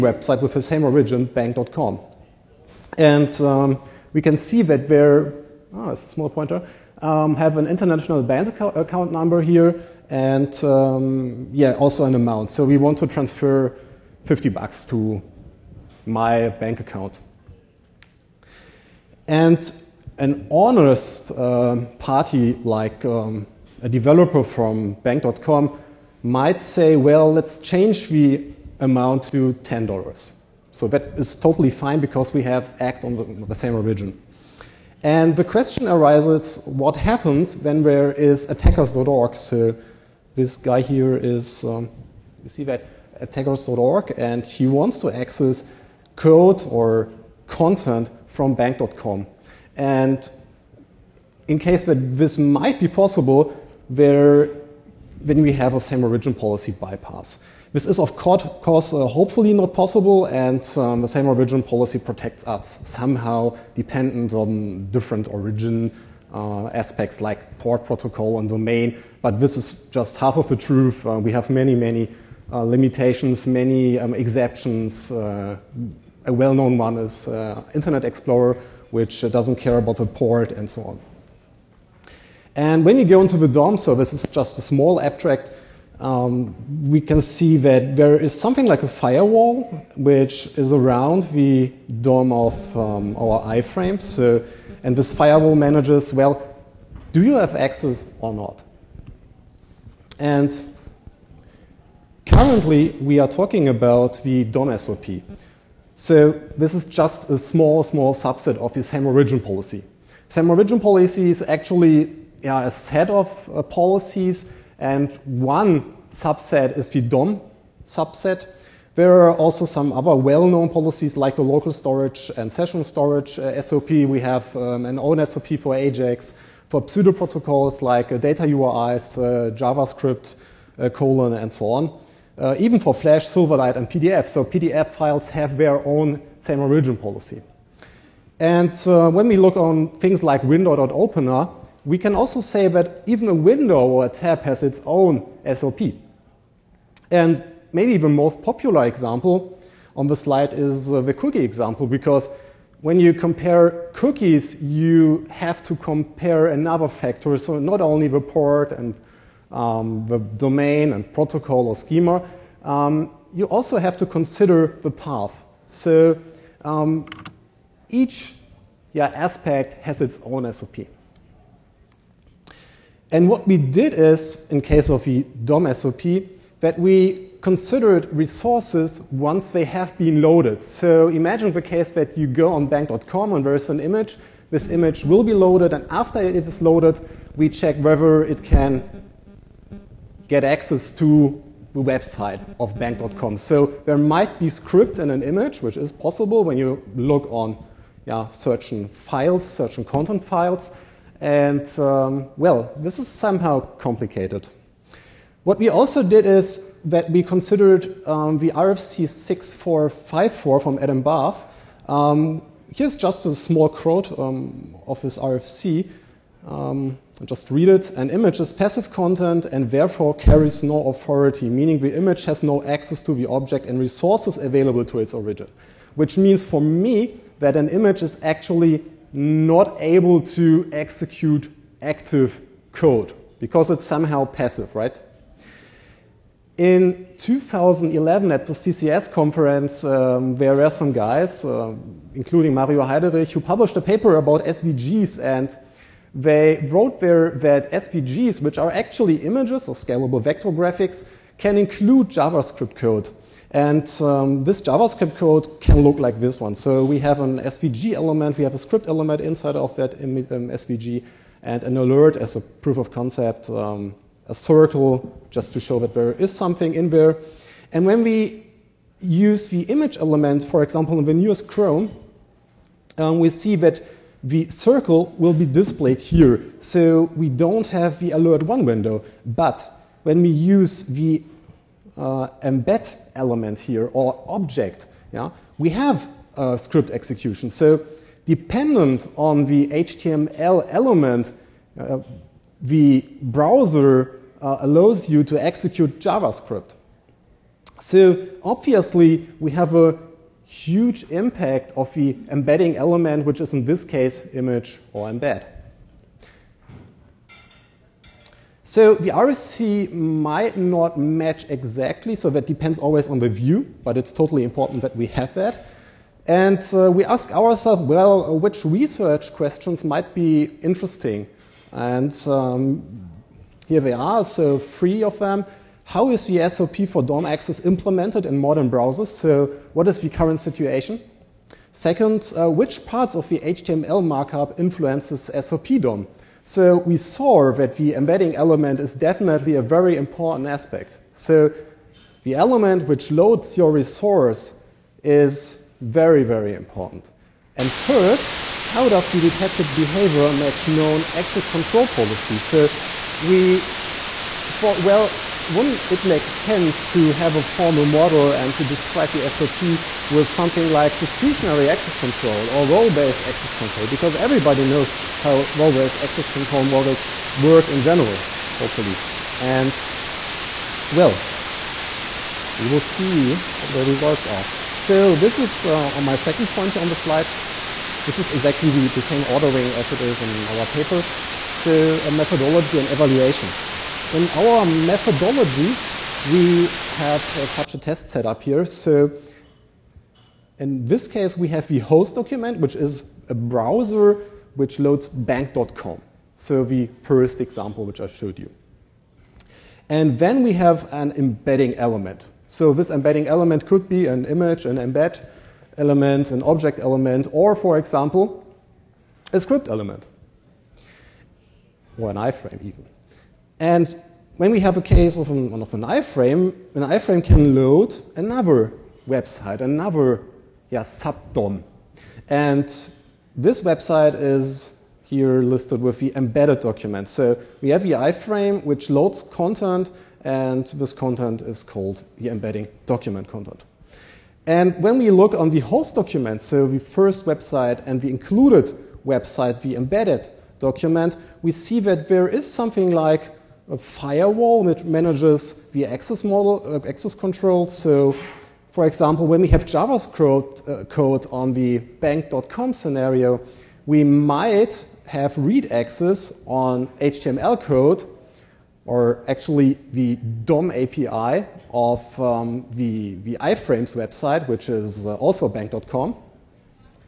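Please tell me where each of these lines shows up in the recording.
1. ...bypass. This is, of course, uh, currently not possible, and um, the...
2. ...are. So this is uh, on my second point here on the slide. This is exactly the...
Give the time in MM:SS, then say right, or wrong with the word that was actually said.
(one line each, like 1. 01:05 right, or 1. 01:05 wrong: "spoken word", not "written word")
1. 00:56 wrong: "hopefully", not "currently"
2. 06:14 right.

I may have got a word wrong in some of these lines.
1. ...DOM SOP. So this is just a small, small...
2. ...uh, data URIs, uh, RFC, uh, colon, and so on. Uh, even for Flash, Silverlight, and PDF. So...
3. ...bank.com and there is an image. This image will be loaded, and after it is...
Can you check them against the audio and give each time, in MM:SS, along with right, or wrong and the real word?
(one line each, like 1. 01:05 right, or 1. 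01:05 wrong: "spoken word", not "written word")
1. 01:44 right
2. 02:08 wrong: "JavaScript", not "RFC"
3. 03:02 right.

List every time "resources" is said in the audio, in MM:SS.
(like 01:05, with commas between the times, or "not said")
02:58, 03:43, 05:43.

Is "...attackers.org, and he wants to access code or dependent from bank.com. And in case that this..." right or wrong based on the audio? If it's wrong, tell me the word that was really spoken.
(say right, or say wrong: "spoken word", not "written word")
wrong: "content", not "dependent".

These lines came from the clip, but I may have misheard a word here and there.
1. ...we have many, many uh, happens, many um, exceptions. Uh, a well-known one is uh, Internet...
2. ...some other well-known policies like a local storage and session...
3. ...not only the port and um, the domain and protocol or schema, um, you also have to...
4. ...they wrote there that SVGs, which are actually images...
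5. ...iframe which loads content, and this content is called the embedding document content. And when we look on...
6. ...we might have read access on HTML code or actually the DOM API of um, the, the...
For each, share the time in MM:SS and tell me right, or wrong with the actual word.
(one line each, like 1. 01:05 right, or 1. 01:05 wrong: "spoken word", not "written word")
1. 01:11 wrong: "limitations", not "happens"
2. 01:59 right
3. 02:37 right
4. 04:06 right
5. 07:07 right
6. 07:33 right.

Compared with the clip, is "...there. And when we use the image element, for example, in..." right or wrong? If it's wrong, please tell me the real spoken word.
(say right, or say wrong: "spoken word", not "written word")
right.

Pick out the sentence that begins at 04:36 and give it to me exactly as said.
So we don't have the alert one window.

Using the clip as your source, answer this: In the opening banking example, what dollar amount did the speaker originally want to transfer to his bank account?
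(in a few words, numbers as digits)
$50.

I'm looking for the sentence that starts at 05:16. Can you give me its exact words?
And uh, we ask ourselves, well, which research questions might be interesting and um, here they are, so three of them.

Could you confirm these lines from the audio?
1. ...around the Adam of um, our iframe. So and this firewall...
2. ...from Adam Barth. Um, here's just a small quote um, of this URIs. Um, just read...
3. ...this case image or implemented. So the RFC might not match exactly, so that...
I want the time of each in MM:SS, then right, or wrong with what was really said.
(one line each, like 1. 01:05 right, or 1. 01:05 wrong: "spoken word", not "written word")
1. 01:30 wrong: "DOM", not "Adam"
2. 03:30 wrong: "RFC", not "URIs"
3. 05:03 wrong: "embed", not "implemented".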